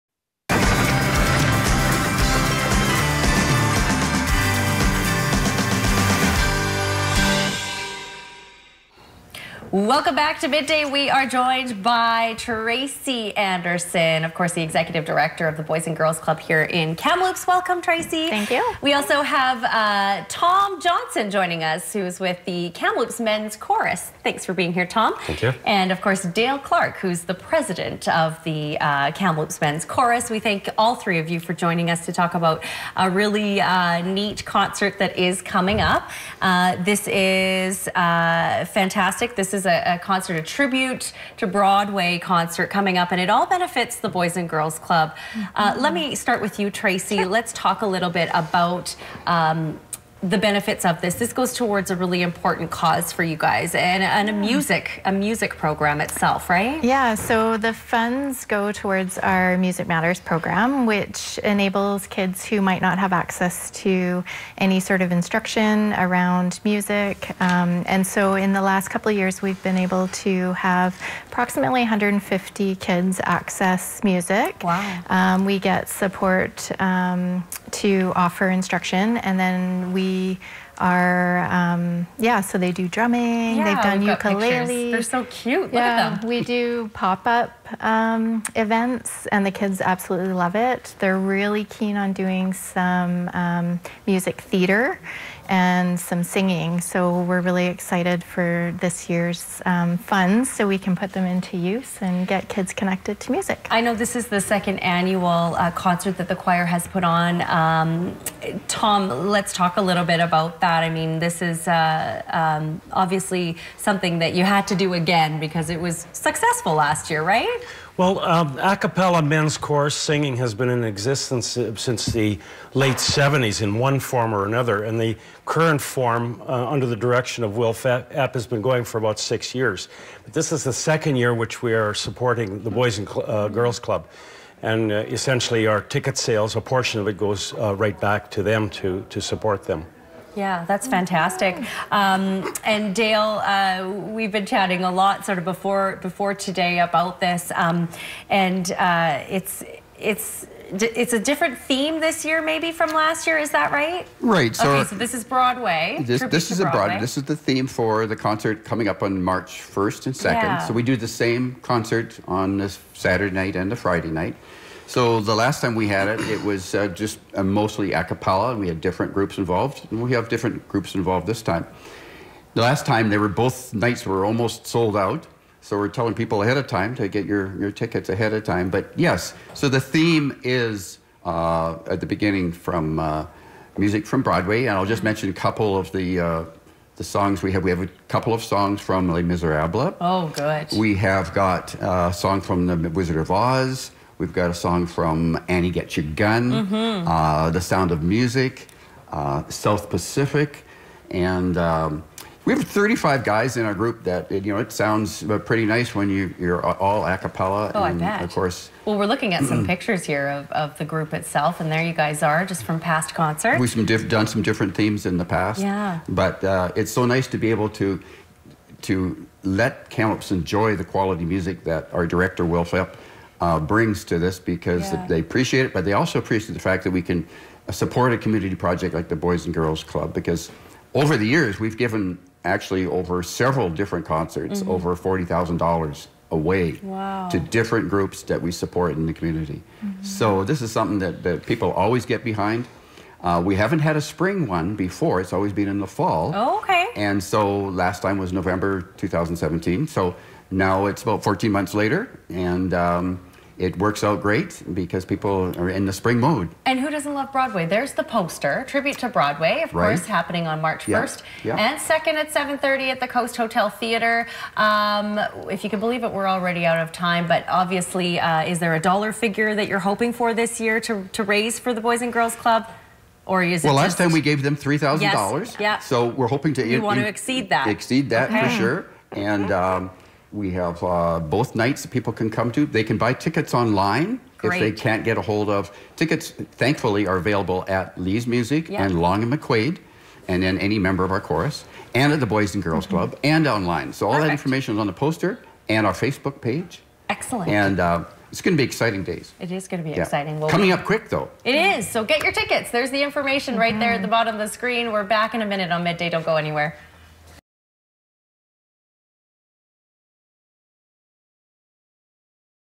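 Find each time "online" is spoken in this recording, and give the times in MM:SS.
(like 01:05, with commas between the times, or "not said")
04:43, 04:53.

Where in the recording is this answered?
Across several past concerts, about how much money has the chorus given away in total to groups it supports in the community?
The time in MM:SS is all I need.
03:54.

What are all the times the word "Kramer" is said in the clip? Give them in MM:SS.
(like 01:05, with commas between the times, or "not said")
not said.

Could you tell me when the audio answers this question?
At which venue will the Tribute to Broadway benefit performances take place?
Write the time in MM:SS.
04:23.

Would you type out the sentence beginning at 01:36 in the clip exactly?
So we're really excited for this year's um, funds so we can put them into use and get kids connected to music.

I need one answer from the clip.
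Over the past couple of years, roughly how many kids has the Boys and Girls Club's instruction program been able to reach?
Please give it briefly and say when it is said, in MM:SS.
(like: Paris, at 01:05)
150, at 01:11.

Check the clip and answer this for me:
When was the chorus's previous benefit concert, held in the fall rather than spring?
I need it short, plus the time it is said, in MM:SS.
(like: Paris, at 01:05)
November 2017, at 04:08.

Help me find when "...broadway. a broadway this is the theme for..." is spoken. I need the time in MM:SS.
02:36.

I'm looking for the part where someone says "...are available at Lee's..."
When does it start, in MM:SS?
04:47.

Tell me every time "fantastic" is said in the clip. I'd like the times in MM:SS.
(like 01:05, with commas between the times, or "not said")
00:38, 02:20.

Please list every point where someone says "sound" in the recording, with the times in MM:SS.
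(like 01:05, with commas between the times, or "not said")
03:17, 03:24.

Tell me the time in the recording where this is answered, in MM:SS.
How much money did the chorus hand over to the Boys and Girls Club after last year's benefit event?
04:34.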